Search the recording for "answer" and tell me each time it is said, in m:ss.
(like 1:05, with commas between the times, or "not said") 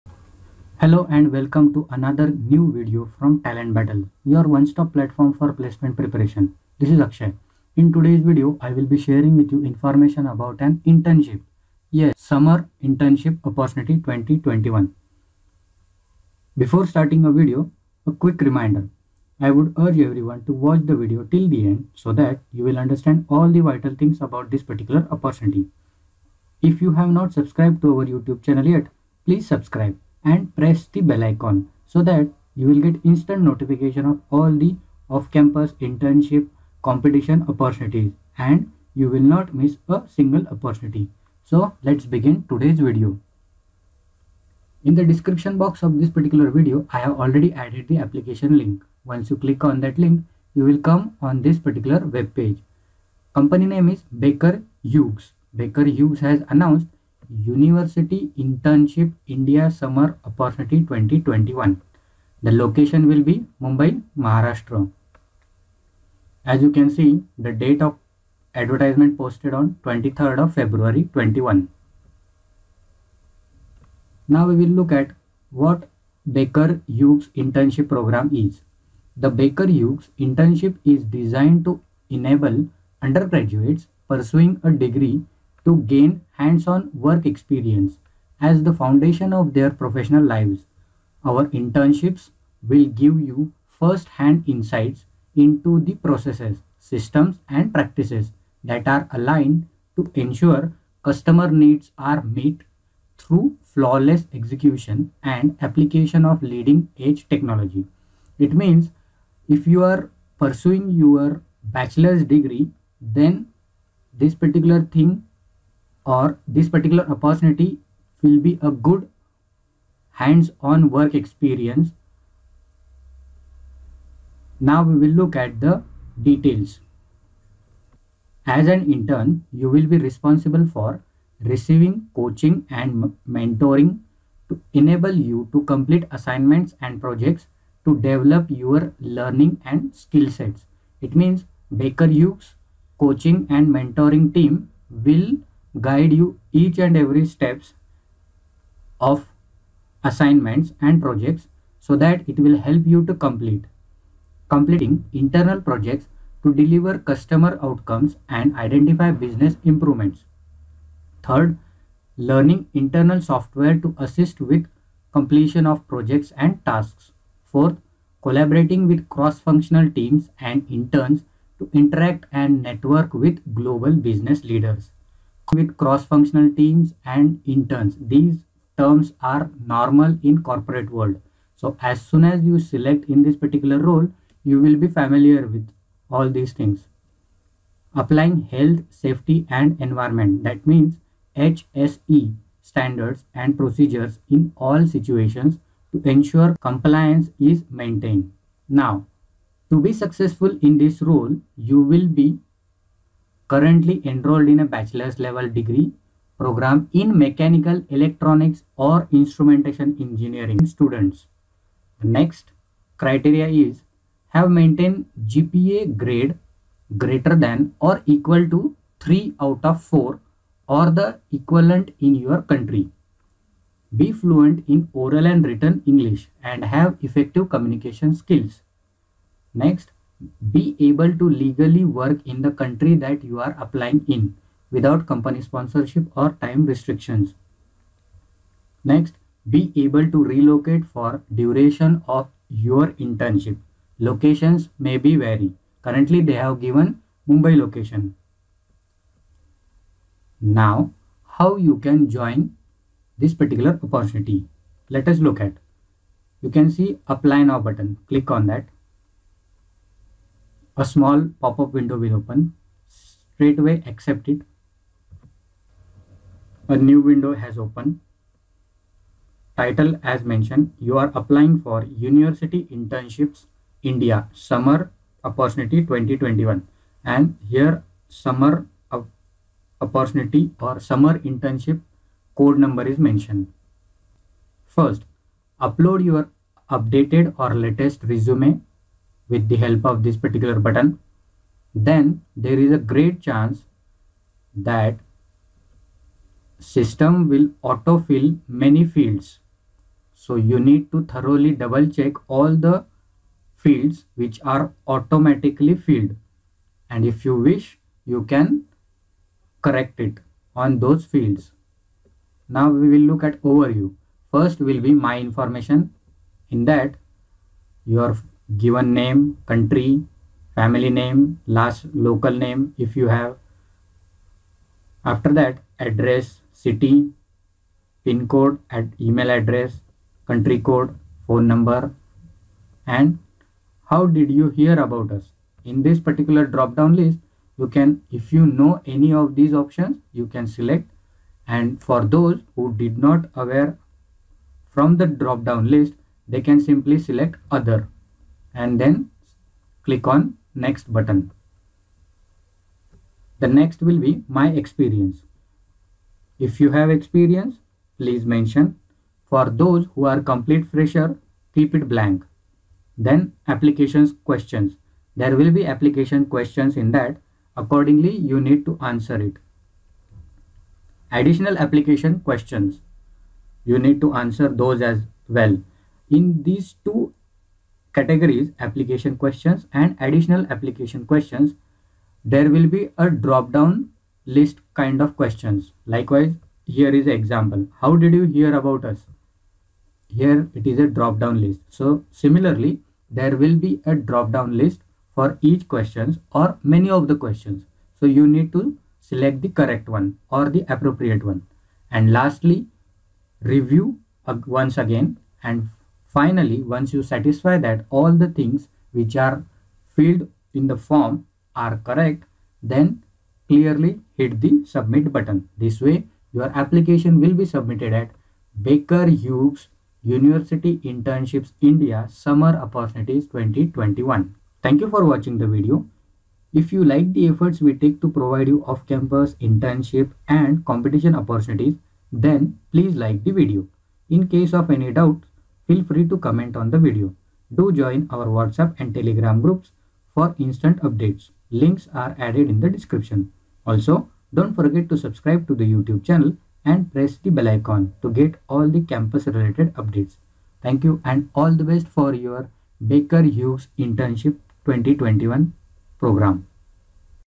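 6:08, 6:14.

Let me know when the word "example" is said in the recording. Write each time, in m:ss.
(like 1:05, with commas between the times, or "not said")
6:27.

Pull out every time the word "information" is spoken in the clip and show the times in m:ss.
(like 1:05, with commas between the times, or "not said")
0:09, 5:15.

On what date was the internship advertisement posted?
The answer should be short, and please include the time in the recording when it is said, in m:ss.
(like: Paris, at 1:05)
23 February 2021, at 1:09.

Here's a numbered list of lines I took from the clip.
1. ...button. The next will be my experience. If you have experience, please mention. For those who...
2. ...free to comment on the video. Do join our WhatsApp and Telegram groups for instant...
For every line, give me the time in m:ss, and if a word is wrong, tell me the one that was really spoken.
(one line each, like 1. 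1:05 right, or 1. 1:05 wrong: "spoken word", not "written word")
1. 5:50 right
2. 7:15 right.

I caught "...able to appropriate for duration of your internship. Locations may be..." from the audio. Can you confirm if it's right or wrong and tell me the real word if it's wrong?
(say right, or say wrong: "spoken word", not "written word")
wrong: "relocate", not "appropriate".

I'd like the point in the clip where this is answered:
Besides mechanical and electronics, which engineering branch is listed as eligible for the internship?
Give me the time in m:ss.
3:29.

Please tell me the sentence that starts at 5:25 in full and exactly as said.
After that, address, city, pin code, ad, email address, country code, phone number, and how did you hear about us?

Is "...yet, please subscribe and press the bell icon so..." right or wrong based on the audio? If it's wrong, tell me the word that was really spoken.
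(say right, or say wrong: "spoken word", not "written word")
right.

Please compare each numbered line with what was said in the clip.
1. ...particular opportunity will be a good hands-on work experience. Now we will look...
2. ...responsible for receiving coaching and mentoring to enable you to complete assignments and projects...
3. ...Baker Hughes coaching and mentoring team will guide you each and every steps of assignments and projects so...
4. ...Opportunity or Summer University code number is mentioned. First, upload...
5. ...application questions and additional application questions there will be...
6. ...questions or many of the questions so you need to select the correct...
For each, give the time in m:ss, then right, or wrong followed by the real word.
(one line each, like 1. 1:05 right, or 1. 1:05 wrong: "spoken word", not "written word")
1. 1:56 right
2. 2:09 right
3. 2:21 right
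4. 4:39 wrong: "Internship", not "University"
5. 6:18 right
6. 6:35 right.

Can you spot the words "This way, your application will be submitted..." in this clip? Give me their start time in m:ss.
6:55.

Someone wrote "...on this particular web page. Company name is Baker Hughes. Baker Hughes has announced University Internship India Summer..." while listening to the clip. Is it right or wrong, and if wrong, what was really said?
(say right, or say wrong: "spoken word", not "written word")
right.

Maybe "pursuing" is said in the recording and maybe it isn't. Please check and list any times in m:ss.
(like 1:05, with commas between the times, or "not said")
1:24, 1:50.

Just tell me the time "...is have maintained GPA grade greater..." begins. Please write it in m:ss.
3:33.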